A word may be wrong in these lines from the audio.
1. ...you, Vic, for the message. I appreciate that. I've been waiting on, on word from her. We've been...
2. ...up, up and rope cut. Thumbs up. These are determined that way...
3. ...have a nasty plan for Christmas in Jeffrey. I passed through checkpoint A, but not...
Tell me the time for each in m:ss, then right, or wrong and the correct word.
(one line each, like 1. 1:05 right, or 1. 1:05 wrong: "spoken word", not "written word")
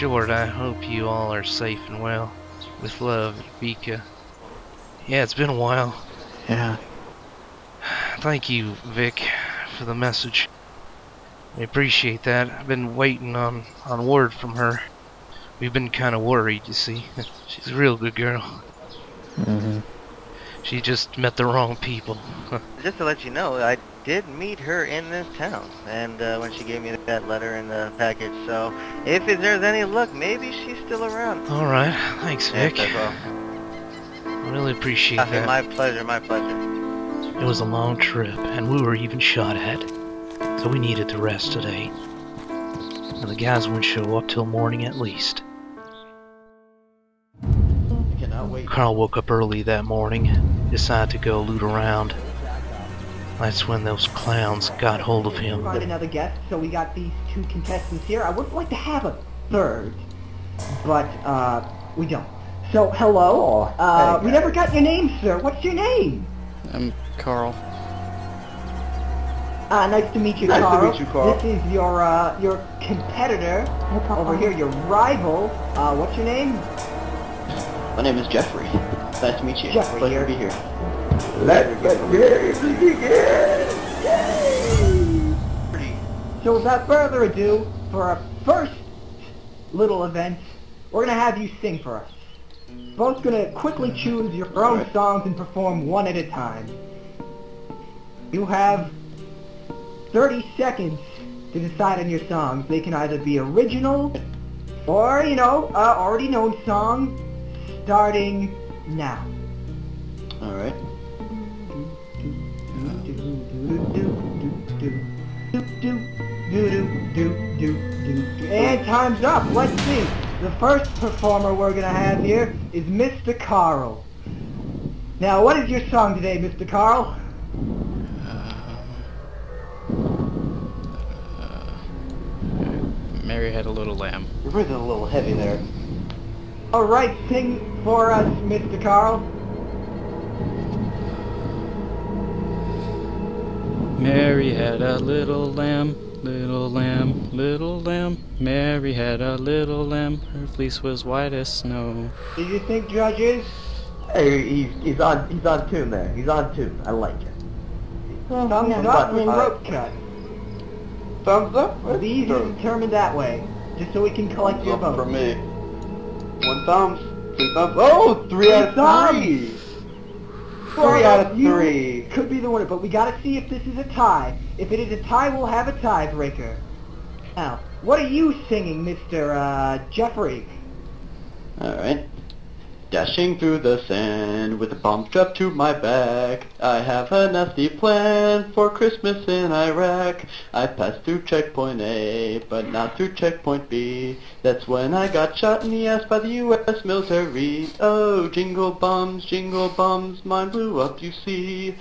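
1. 0:08 right
2. 2:38 right
3. 3:06 wrong: "Iraq", not "Jeffrey".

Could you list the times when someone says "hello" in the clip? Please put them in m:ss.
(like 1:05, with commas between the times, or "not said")
1:02.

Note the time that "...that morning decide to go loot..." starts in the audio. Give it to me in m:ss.
0:49.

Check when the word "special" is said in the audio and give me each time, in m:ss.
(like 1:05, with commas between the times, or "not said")
not said.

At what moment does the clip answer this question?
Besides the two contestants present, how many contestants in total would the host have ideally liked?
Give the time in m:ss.
0:59.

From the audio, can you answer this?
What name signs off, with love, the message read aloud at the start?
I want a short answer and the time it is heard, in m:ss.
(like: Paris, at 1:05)
Vika, at 0:03.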